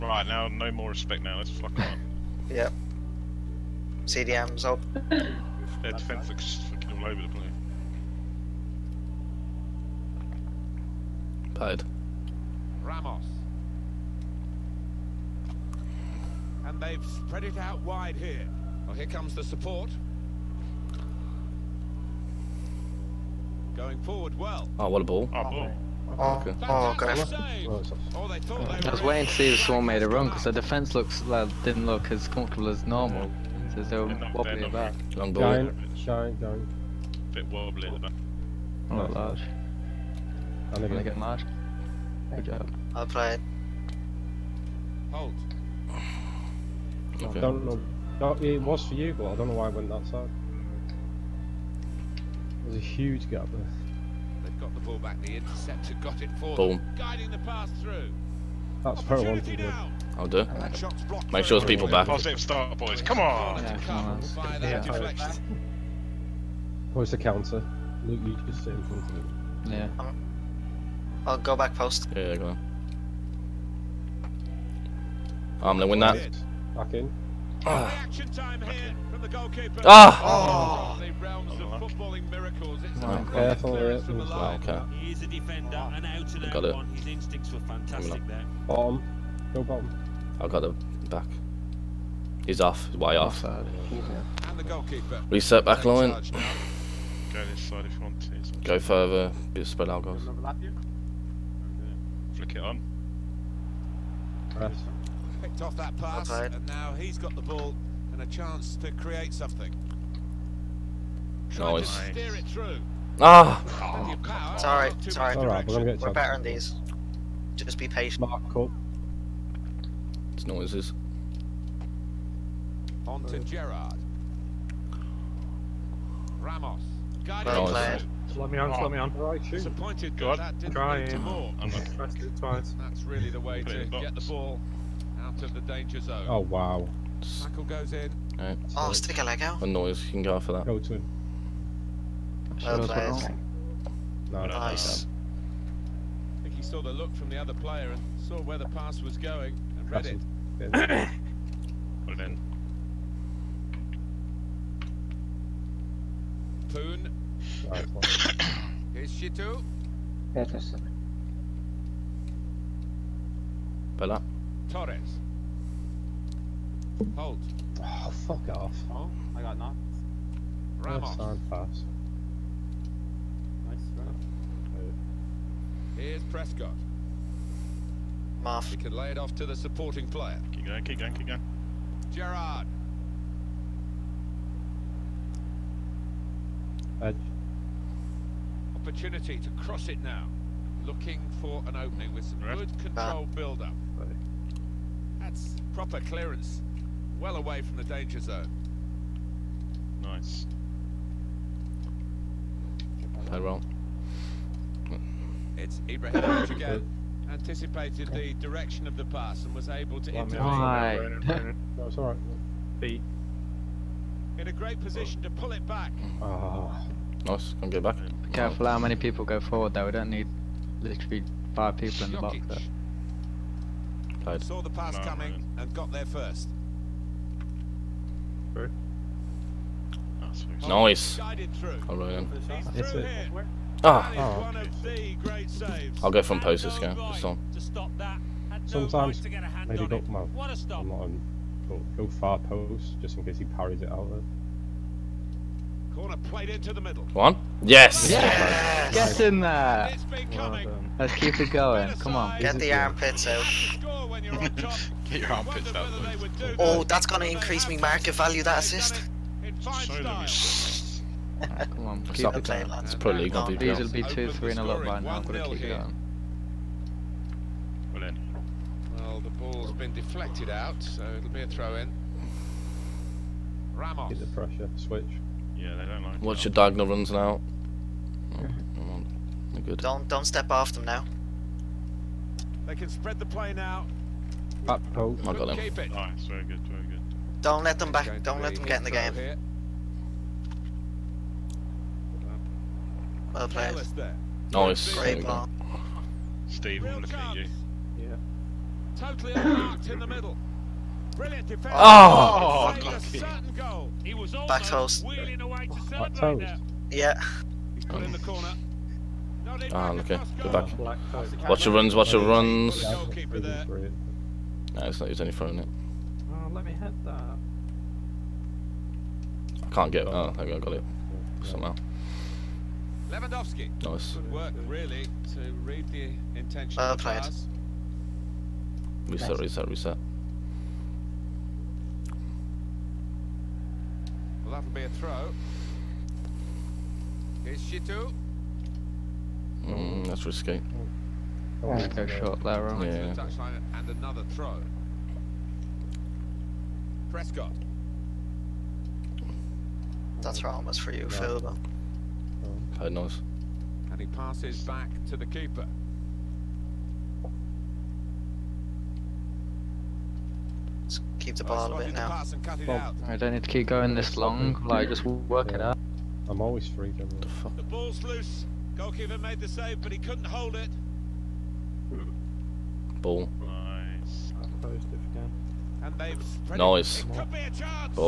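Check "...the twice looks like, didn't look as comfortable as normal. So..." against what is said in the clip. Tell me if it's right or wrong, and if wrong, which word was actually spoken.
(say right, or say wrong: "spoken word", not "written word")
wrong: "defence", not "twice".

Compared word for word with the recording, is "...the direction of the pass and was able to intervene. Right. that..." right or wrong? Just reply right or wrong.
right.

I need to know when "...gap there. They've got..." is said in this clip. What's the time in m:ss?
0:53.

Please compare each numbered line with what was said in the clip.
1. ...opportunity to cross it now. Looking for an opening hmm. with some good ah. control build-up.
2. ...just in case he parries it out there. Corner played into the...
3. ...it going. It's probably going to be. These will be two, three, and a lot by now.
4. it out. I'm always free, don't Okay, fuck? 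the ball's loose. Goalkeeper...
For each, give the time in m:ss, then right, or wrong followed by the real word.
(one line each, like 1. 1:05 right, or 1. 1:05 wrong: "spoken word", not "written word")
1. 3:08 right
2. 4:03 right
3. 4:22 right
4. 6:05 wrong: "The", not "Okay".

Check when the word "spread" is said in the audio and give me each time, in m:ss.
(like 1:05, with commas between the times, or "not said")
0:17, 1:39, 4:42.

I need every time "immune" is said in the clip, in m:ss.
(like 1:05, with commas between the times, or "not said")
not said.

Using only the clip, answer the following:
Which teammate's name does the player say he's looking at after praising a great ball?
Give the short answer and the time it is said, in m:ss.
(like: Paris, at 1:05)
Steve, at 4:56.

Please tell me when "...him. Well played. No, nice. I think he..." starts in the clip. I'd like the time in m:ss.
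2:20.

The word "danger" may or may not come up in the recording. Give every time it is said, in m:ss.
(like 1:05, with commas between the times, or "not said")
2:15, 3:17.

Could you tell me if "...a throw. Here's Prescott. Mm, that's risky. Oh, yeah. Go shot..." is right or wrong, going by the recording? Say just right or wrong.
wrong.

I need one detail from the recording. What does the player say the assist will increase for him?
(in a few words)
market value.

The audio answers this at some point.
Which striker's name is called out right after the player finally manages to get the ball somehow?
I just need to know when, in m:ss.
5:23.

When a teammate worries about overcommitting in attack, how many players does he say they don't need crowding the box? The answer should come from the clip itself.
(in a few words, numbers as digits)
5.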